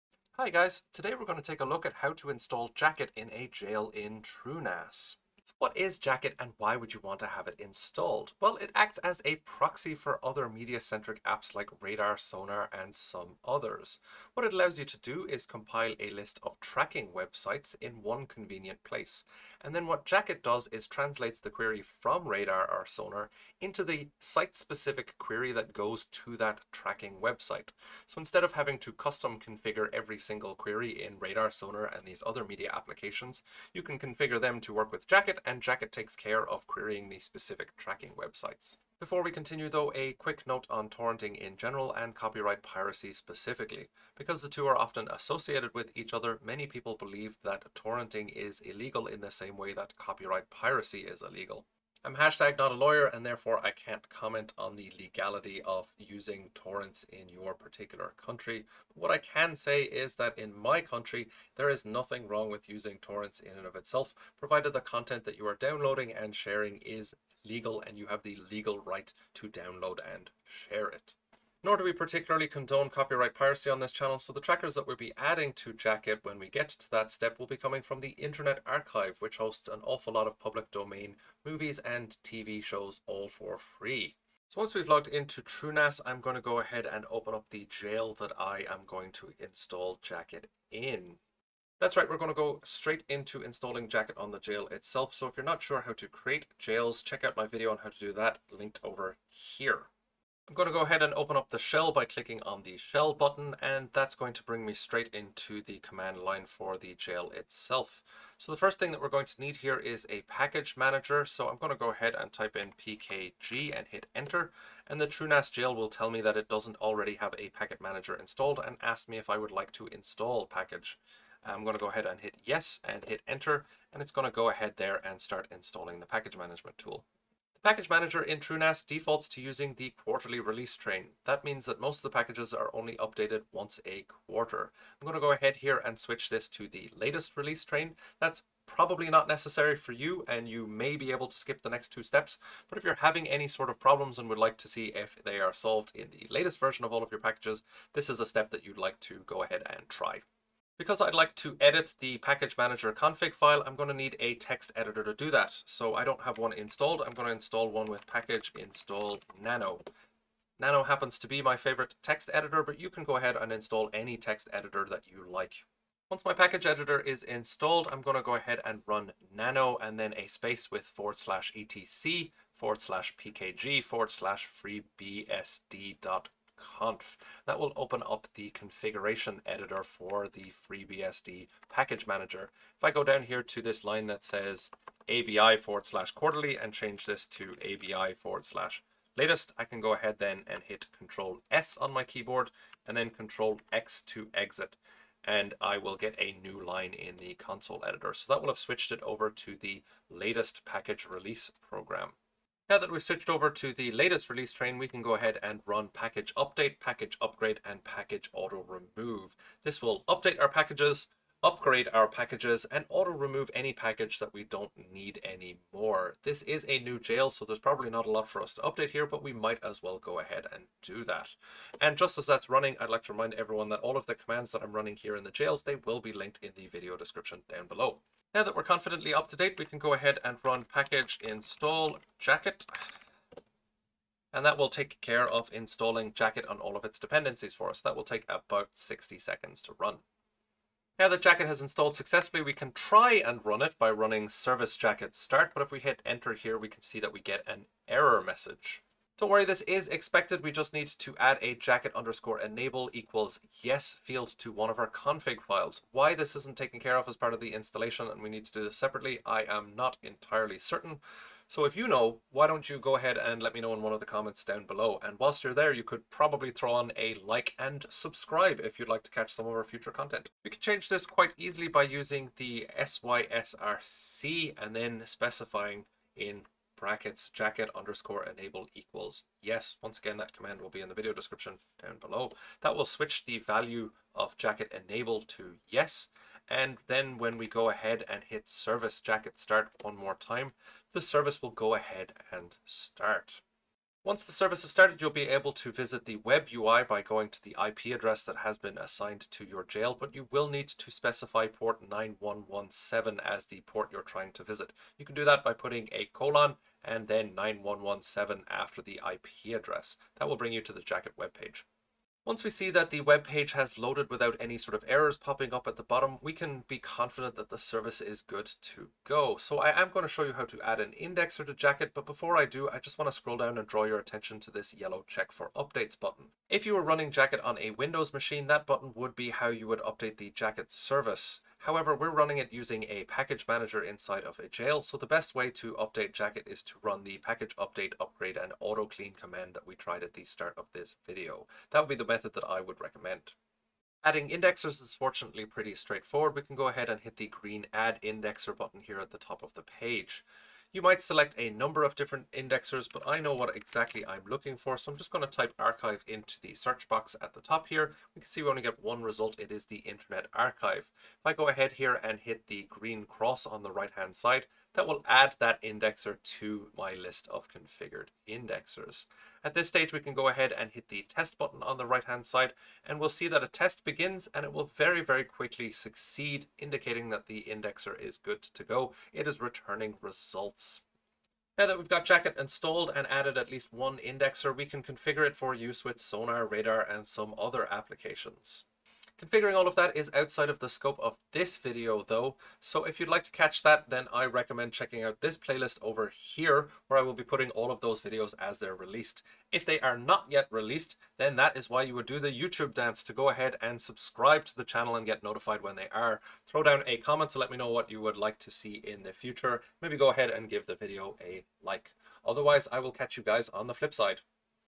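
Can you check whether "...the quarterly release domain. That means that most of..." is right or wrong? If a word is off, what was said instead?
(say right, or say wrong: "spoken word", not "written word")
wrong: "train", not "domain".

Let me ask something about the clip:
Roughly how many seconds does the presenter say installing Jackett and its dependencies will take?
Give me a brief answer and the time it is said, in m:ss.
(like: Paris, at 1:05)
60, at 3:58.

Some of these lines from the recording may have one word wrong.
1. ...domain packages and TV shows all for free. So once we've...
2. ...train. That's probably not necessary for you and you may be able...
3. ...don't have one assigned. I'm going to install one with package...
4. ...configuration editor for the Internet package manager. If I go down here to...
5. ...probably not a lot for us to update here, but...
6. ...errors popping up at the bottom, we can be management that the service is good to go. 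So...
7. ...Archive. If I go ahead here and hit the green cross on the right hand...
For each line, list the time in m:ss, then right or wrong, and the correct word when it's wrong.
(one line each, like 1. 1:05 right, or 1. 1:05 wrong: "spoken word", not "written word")
1. 1:20 wrong: "movies", not "packages"
2. 2:17 right
3. 2:36 wrong: "installed", not "assigned"
4. 2:58 wrong: "FreeBSD", not "Internet"
5. 3:37 right
6. 5:14 wrong: "confident", not "management"
7. 6:00 right.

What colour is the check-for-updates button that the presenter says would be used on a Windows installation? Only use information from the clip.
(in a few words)
yellow.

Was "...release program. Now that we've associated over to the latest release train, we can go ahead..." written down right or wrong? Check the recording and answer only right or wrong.
wrong.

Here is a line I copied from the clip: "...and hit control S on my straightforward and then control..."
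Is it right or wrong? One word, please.
wrong.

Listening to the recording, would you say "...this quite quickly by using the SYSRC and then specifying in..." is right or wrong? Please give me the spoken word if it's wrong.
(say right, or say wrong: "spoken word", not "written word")
wrong: "easily", not "quickly".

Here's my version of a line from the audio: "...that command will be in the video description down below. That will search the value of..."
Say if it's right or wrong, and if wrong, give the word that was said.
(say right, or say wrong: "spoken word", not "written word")
wrong: "switch", not "search".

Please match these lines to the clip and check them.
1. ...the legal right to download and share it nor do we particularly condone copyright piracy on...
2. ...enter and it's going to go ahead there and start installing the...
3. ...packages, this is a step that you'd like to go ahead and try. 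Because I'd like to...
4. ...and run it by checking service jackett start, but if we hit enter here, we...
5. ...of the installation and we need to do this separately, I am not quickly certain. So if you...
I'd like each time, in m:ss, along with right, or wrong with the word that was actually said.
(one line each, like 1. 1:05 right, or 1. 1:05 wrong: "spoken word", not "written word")
1. 1:08 right
2. 2:03 right
3. 2:27 right
4. 4:03 wrong: "running", not "checking"
5. 4:17 wrong: "entirely", not "quickly".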